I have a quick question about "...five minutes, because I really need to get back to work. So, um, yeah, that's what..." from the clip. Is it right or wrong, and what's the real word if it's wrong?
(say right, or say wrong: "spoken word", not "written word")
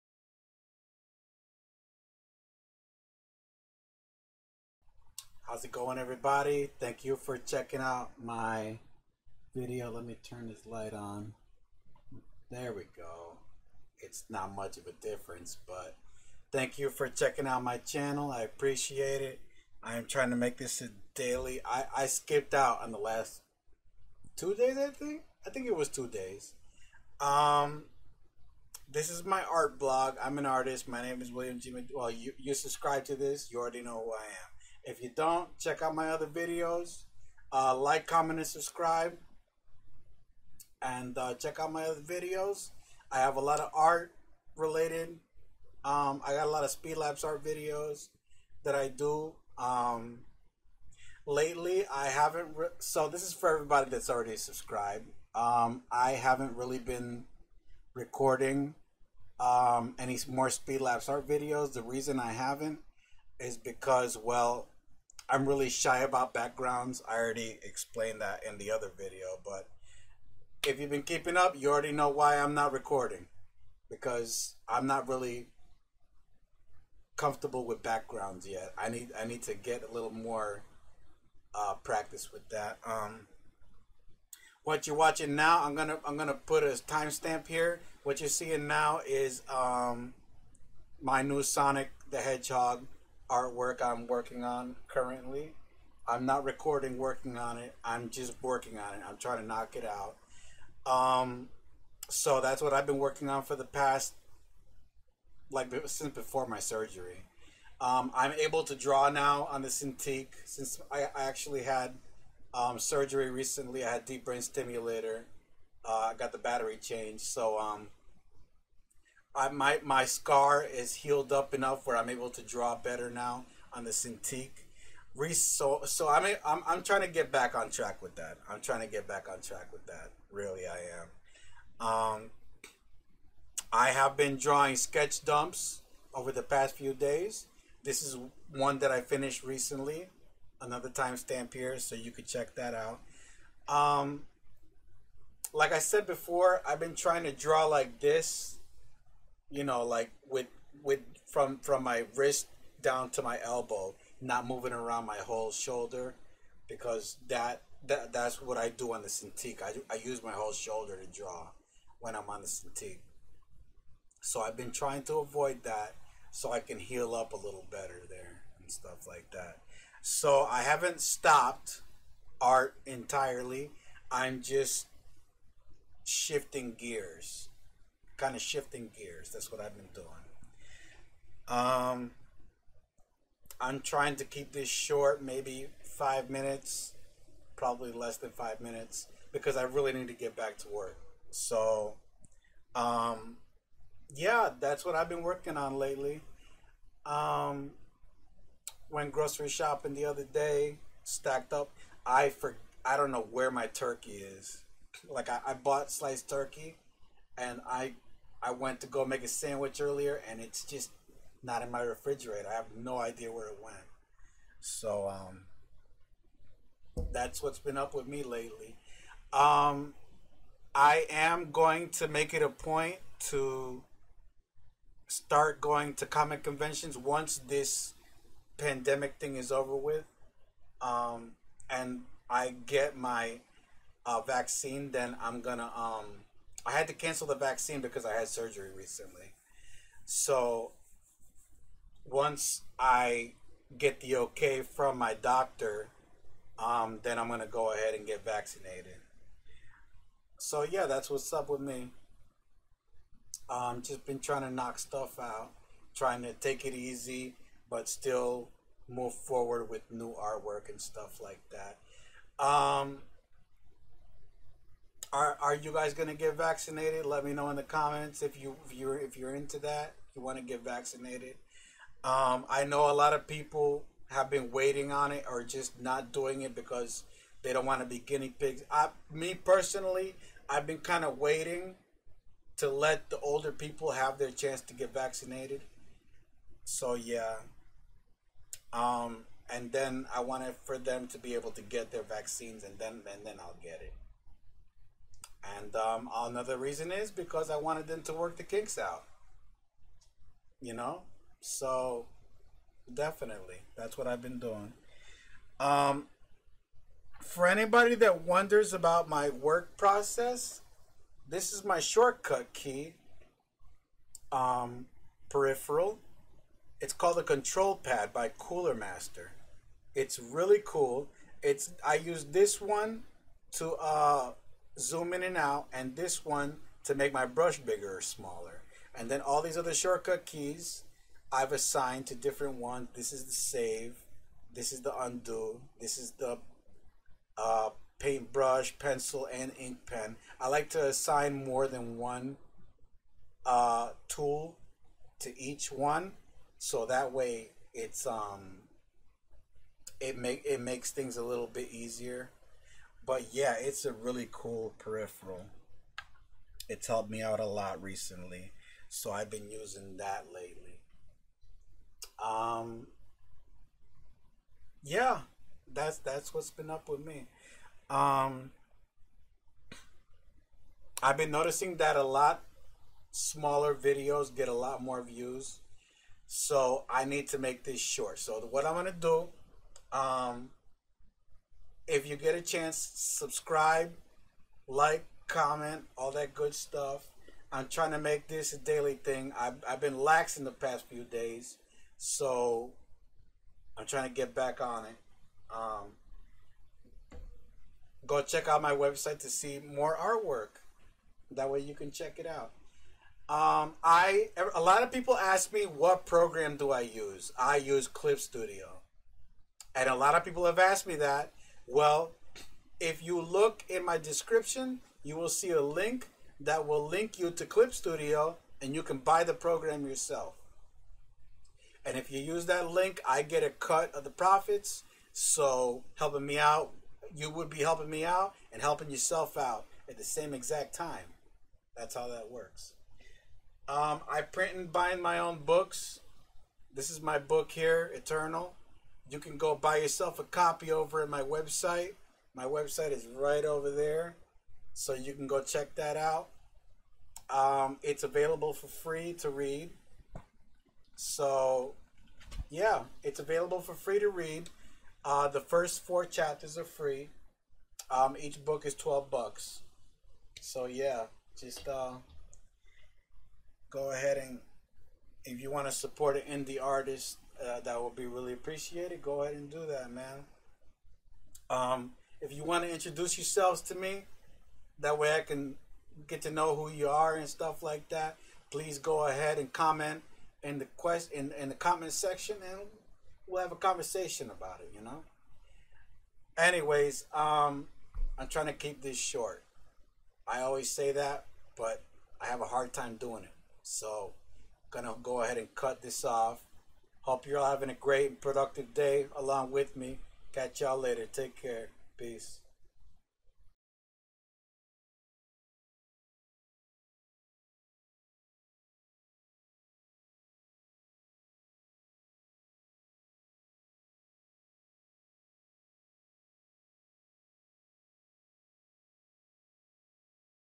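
right.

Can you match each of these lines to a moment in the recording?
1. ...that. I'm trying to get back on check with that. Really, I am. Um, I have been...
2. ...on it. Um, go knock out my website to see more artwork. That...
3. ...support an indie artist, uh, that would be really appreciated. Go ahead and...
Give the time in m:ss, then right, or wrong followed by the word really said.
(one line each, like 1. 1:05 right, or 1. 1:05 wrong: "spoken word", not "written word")
1. 2:08 wrong: "track", not "check"
2. 6:34 wrong: "check", not "knock"
3. 7:45 right.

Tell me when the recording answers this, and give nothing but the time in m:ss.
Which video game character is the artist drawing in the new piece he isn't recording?
1:31.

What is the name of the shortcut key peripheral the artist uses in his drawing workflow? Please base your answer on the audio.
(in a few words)
Control Pad.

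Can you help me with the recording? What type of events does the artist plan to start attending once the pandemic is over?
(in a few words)
Comic conventions.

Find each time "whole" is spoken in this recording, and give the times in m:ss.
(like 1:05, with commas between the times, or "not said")
2:35, 2:40.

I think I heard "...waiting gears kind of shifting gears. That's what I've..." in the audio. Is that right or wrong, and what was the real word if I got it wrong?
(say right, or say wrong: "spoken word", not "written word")
wrong: "shifting", not "waiting".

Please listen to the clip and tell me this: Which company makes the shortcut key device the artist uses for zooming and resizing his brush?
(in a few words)
Cooler Master.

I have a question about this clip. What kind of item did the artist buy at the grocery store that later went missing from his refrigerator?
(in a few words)
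Sliced turkey.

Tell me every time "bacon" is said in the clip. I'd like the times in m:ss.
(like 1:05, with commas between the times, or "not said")
not said.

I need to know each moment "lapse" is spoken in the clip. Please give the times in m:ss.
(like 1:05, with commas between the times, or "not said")
0:46, 1:00.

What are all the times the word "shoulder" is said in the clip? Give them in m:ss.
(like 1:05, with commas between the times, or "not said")
2:35, 2:40.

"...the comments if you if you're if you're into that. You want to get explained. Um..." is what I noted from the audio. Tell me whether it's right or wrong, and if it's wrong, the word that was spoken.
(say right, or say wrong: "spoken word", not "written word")
wrong: "vaccinated", not "explained".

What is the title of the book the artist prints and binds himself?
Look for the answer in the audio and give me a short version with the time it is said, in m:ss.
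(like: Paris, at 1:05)
Eternal, at 7:17.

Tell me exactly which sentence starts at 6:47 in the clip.
I use Clip Studio, and a lot of people have asked me that.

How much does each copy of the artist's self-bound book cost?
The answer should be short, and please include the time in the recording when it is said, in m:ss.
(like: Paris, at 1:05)
$12, at 7:38.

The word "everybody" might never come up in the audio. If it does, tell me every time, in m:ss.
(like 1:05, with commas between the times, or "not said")
0:05, 0:53.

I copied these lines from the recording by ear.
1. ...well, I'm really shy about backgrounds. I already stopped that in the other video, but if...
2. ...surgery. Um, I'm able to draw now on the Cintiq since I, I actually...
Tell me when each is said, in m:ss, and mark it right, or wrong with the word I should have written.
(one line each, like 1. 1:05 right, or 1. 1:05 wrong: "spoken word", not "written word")
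1. 1:04 wrong: "explained", not "stopped"
2. 1:46 right.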